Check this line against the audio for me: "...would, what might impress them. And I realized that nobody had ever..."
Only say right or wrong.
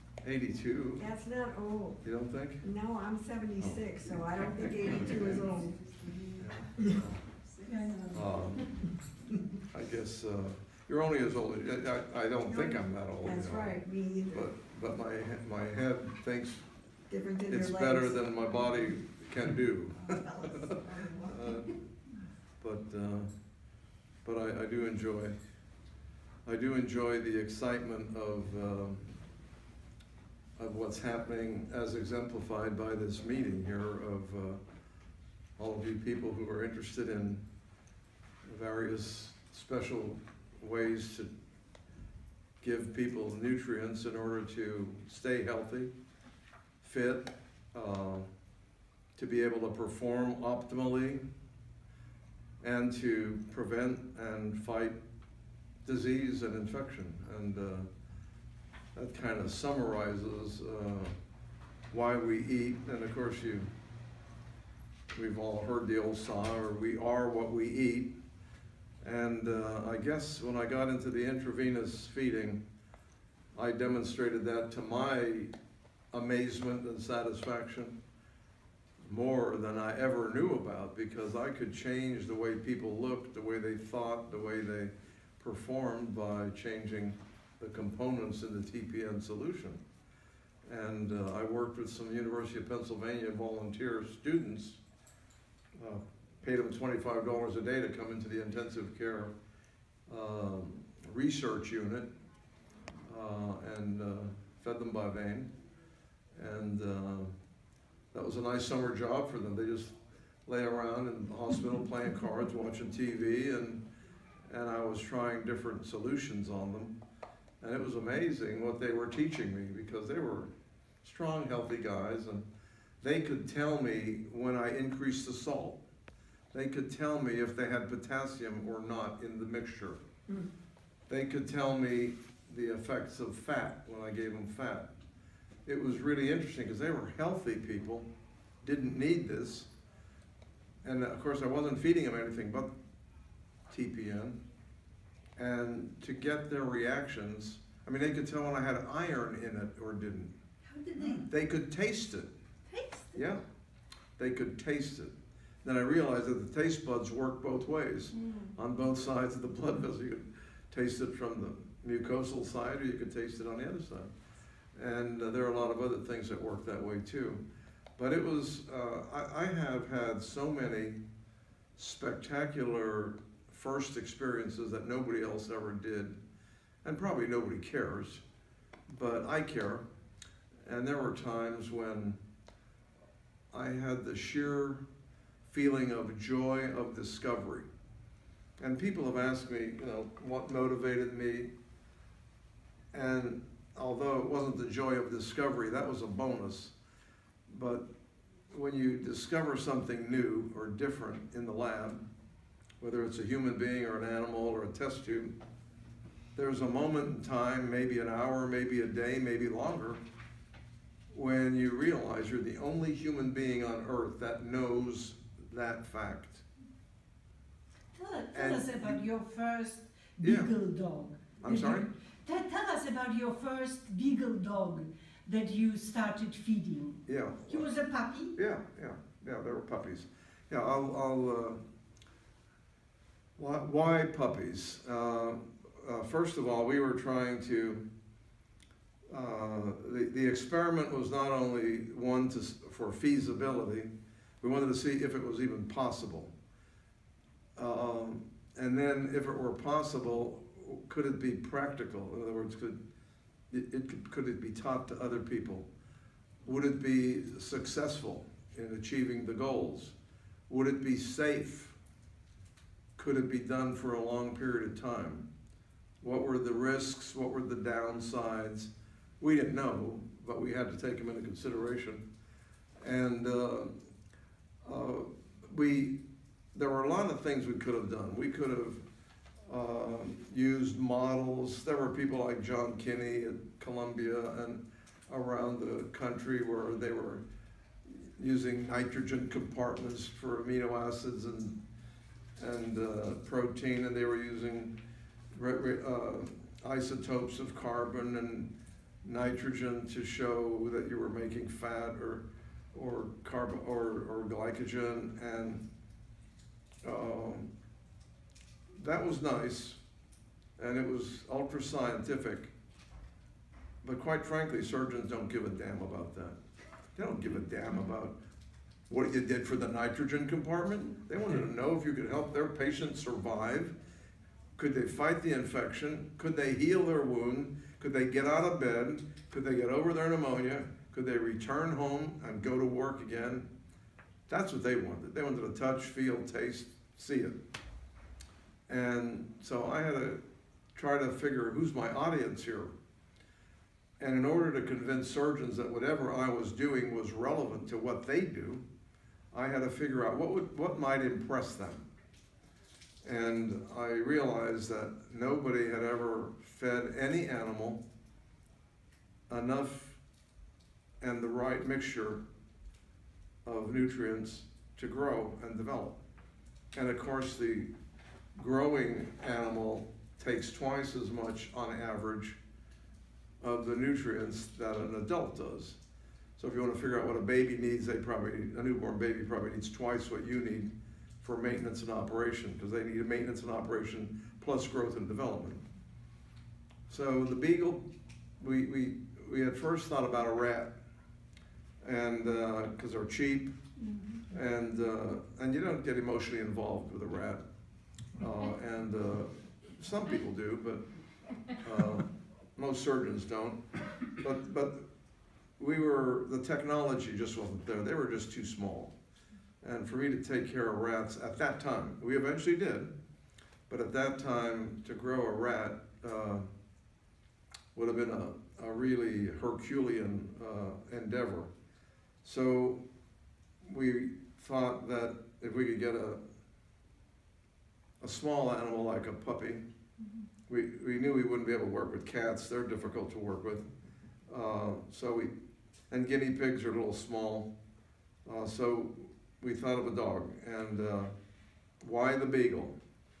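right.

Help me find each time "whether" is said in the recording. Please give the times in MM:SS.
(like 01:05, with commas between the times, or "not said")
03:22.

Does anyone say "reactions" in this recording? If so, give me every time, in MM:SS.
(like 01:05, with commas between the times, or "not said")
02:26.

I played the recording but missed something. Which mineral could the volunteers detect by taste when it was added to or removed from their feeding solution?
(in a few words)
Iron.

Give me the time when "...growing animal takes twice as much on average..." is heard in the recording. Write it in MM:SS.
06:08.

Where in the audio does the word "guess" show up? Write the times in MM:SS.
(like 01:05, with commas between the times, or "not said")
00:09, 01:09.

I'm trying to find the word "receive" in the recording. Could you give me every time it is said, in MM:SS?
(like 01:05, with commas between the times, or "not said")
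not said.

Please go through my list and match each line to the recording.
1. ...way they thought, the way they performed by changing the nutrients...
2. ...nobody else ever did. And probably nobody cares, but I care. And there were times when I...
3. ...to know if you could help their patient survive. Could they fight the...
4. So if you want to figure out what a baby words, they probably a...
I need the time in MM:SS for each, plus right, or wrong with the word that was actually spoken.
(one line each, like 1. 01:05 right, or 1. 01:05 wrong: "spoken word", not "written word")
1. 01:23 wrong: "components", not "nutrients"
2. 02:54 right
3. 05:21 right
4. 06:16 wrong: "needs", not "words".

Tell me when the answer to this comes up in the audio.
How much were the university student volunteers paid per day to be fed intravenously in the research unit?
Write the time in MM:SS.
01:36.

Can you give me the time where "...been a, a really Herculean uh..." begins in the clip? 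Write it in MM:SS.
06:57.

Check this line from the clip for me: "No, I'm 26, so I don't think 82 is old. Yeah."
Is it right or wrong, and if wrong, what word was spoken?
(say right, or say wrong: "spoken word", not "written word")
wrong: "76", not "26".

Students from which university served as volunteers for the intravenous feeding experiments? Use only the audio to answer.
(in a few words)
University of Pennsylvania.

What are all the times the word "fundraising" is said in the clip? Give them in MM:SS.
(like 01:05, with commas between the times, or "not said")
not said.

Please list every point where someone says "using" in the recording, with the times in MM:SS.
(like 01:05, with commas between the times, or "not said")
04:48, 04:54.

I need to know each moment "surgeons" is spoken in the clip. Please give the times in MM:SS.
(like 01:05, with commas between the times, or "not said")
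05:14, 05:45, 06:42.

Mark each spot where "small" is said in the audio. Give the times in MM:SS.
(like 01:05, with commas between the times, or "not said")
06:48, 07:08, 07:17.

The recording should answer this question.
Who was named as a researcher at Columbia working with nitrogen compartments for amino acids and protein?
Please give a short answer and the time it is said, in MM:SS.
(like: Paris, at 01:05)
John Kinney, at 04:42.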